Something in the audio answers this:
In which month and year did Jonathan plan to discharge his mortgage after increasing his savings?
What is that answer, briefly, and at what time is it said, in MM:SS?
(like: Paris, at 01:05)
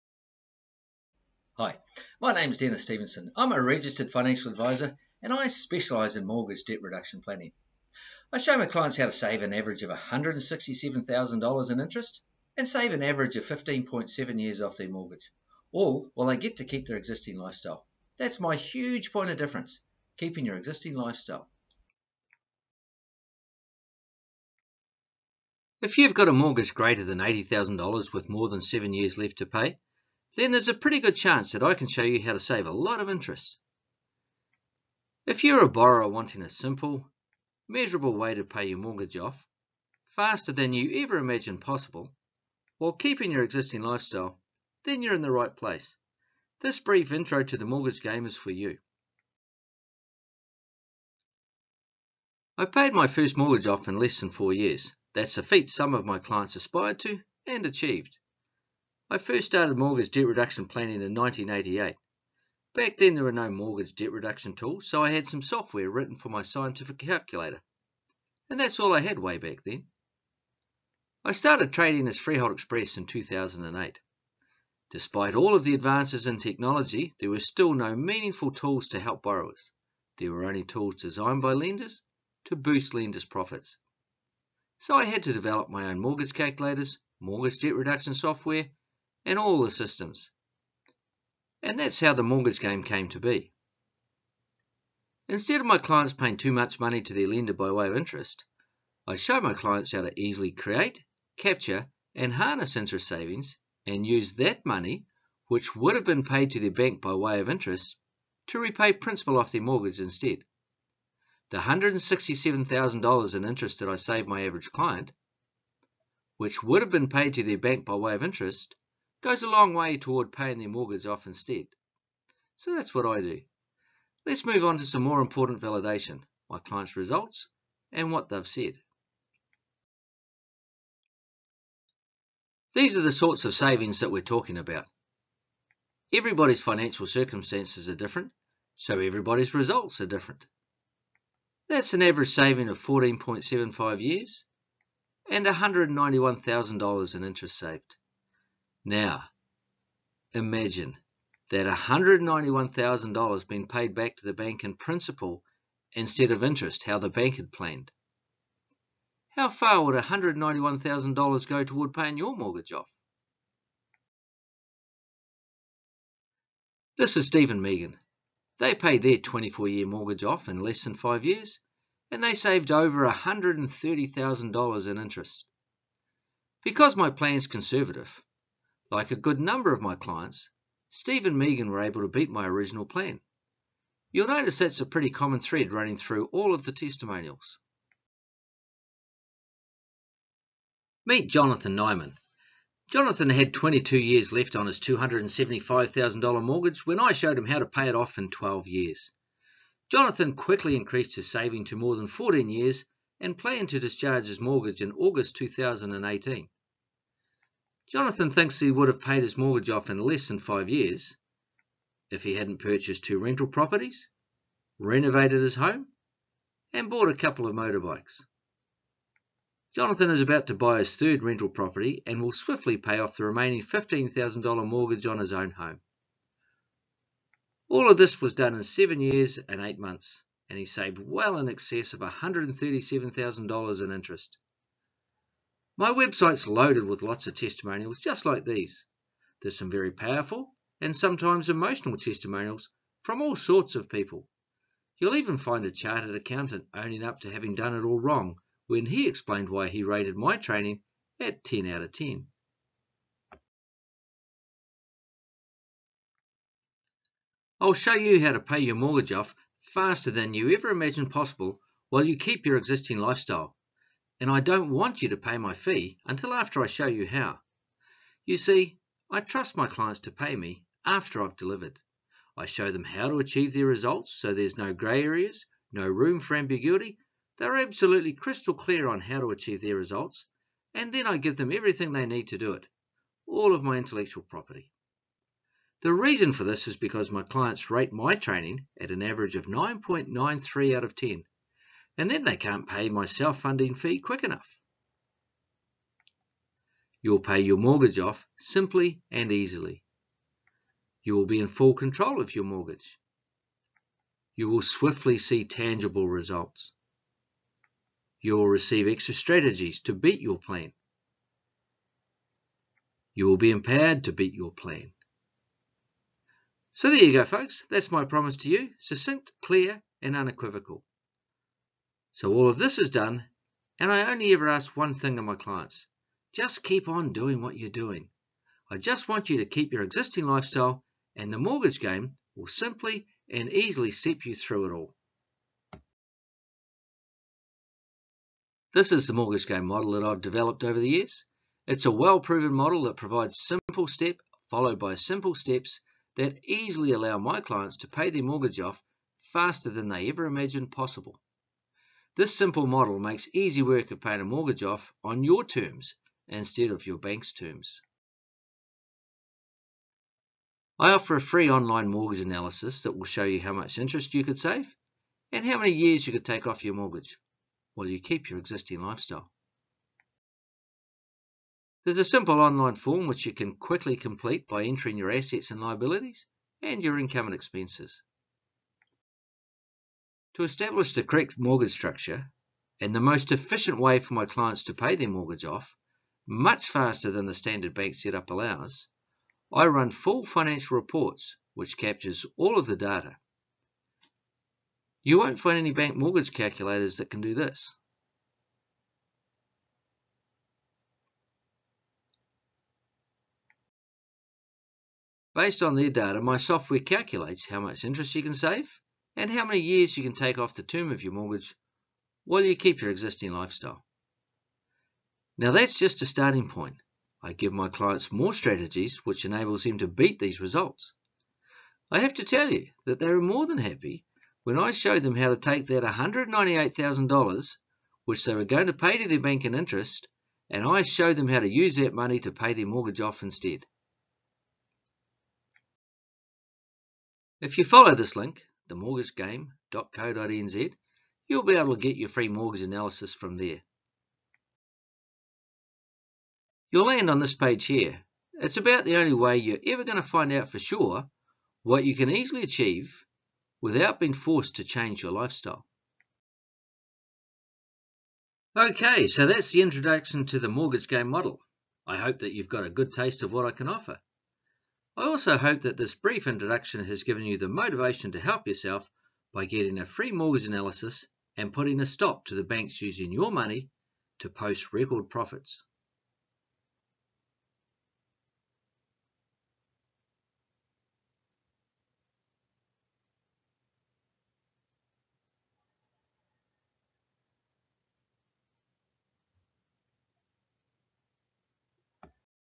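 August 2018, at 03:24.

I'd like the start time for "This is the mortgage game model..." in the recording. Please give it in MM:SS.
05:38.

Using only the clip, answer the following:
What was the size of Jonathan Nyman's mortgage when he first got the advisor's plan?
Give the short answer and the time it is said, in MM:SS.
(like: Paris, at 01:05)
$275,000, at 03:14.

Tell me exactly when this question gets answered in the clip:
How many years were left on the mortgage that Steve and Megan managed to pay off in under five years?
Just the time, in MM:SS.
02:49.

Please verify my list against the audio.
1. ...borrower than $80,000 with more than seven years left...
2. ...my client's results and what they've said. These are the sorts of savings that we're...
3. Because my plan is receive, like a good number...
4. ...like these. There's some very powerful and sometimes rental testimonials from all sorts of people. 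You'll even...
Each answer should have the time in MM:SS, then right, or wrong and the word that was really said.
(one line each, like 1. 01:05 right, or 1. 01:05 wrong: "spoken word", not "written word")
1. 00:26 wrong: "greater", not "borrower"
2. 02:06 right
3. 02:56 wrong: "conservative", not "receive"
4. 03:58 wrong: "emotional", not "rental".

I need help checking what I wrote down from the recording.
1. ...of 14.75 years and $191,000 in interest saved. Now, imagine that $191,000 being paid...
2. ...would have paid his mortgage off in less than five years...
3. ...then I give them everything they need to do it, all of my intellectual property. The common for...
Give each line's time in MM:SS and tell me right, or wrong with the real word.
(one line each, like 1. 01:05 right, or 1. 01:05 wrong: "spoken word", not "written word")
1. 02:22 right
2. 03:28 right
3. 04:40 wrong: "reason", not "common".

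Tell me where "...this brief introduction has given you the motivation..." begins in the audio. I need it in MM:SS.
07:45.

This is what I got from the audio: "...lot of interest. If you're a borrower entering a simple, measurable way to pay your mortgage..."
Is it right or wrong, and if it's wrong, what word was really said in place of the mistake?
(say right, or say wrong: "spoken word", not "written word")
wrong: "wanting", not "entering".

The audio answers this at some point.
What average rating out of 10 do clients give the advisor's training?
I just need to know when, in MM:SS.
04:49.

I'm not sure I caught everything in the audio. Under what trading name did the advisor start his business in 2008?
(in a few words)
Freehold Express.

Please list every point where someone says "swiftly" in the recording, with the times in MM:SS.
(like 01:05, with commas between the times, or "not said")
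03:42, 05:04.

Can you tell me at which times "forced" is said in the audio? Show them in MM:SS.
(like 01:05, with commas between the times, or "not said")
07:34.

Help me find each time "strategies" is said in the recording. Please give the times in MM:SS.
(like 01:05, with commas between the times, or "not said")
05:09, 06:58.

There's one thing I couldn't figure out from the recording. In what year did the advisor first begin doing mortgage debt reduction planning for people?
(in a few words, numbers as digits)
1988.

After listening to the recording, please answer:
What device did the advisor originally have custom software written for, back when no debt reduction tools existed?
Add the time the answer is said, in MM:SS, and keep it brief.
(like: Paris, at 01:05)
scientific calculator, at 01:06.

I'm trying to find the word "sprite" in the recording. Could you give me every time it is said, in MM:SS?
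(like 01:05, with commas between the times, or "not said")
not said.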